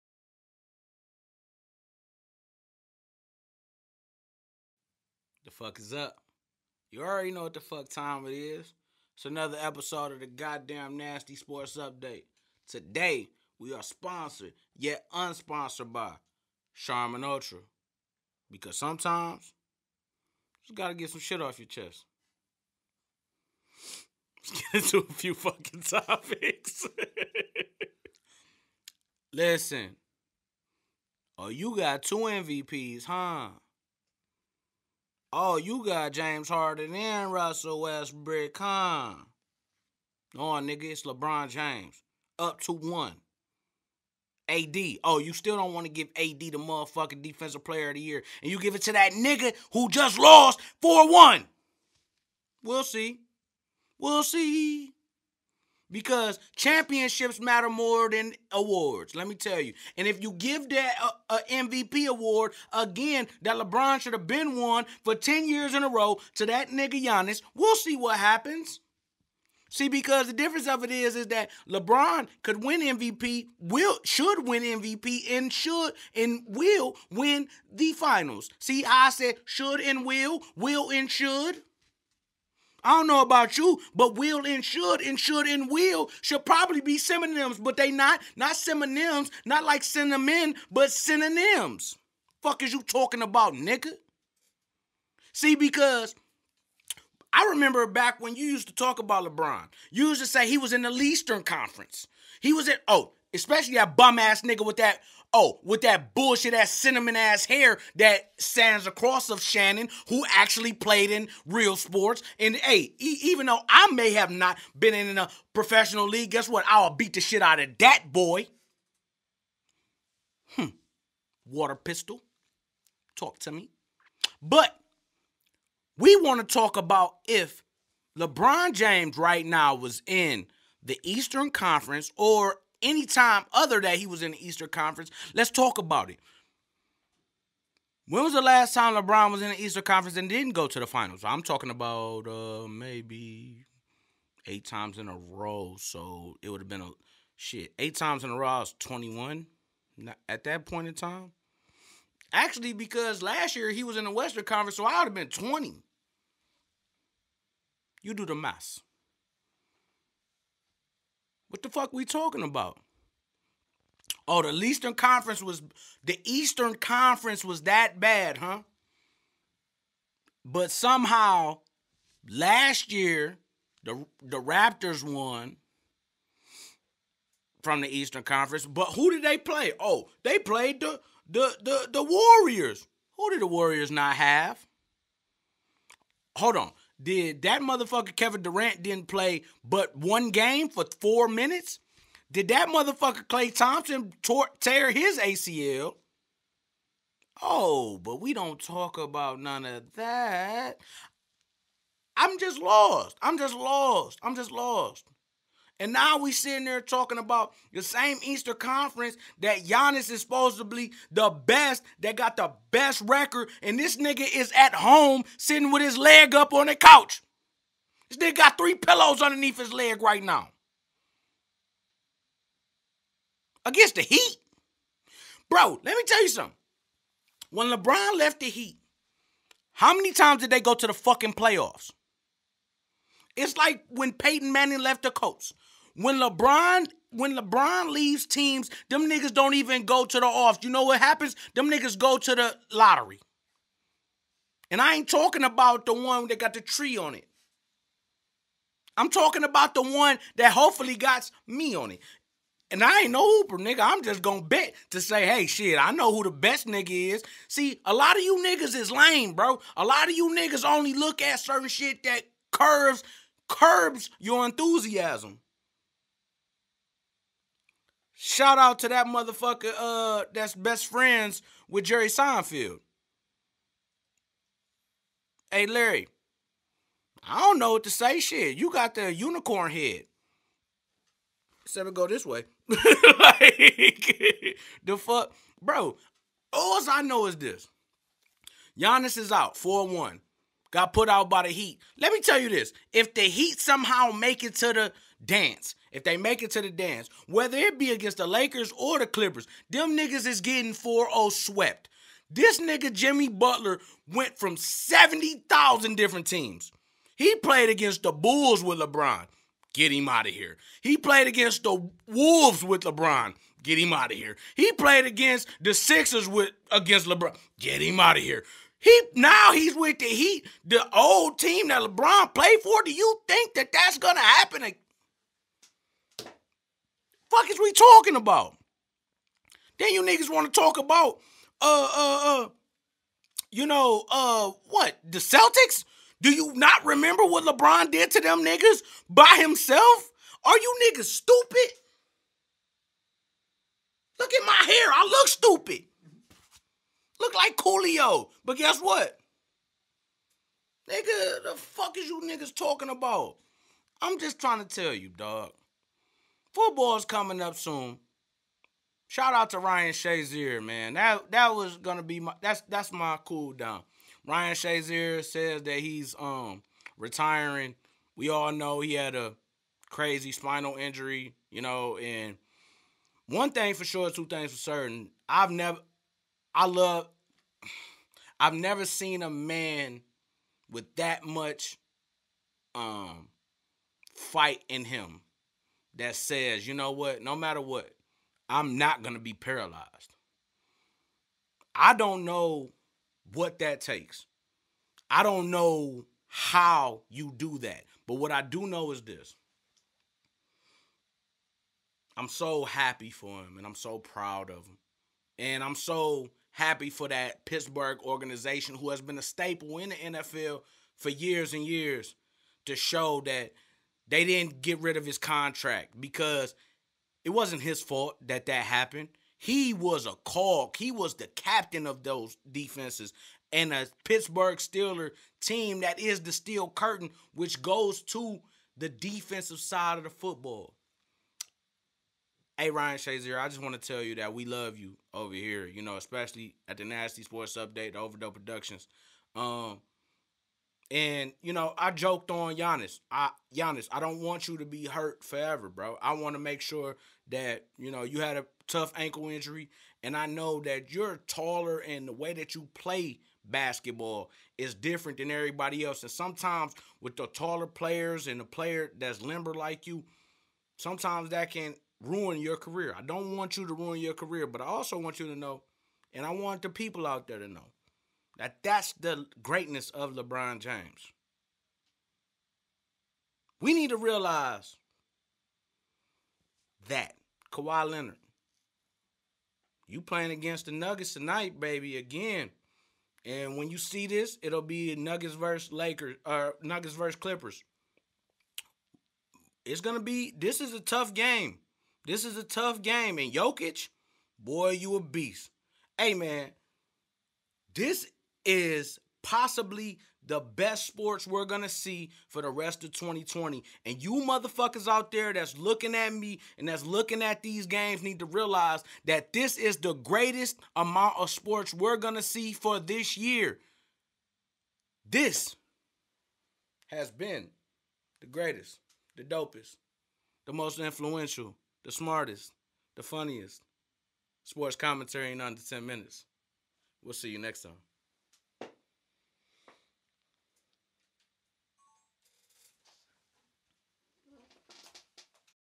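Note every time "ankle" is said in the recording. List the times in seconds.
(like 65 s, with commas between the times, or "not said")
448 s.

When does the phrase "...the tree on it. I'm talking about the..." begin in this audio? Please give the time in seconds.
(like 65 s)
246 s.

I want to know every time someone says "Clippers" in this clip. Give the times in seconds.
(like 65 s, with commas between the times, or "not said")
299 s, 487 s.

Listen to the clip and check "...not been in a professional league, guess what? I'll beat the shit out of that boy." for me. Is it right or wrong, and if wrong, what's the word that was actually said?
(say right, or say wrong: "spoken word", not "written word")
right.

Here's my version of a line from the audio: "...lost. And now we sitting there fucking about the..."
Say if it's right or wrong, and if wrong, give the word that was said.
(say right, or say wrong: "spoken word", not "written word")
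wrong: "talking", not "fucking".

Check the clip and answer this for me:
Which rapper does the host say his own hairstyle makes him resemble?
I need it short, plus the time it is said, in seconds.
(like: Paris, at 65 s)
Coolio, at 347 s.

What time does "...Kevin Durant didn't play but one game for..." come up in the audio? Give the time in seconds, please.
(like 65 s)
188 s.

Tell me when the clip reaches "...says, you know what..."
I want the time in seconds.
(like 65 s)
386 s.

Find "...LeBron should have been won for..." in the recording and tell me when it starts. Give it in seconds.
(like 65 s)
63 s.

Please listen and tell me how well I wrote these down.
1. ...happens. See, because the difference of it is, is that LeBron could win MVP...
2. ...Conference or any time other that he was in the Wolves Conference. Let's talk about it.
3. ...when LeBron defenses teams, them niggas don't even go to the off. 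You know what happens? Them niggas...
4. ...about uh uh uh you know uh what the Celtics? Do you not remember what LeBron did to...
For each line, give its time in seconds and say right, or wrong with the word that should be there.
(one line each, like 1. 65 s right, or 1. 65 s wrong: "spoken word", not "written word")
1. 68 s right
2. 131 s wrong: "Eastern", not "Wolves"
3. 237 s wrong: "leaves", not "defenses"
4. 330 s right.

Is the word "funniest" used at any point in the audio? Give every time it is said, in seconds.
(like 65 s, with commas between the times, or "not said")
523 s.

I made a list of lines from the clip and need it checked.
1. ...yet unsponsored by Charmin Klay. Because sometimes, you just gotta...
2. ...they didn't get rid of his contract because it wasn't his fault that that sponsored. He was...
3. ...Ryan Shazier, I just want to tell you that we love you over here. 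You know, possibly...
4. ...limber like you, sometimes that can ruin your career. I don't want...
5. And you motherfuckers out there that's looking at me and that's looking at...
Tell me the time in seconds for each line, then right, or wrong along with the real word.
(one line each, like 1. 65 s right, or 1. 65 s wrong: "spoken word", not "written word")
1. 14 s wrong: "Ultra", not "Klay"
2. 414 s wrong: "happened", not "sponsored"
3. 432 s wrong: "especially", not "possibly"
4. 459 s right
5. 503 s right.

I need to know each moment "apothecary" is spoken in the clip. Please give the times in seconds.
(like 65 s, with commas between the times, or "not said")
not said.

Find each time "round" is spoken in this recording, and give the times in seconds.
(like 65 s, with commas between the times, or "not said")
not said.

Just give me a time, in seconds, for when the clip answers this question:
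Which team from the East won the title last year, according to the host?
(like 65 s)
174 s.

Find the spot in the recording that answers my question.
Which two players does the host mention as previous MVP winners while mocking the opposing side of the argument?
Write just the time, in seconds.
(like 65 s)
36 s.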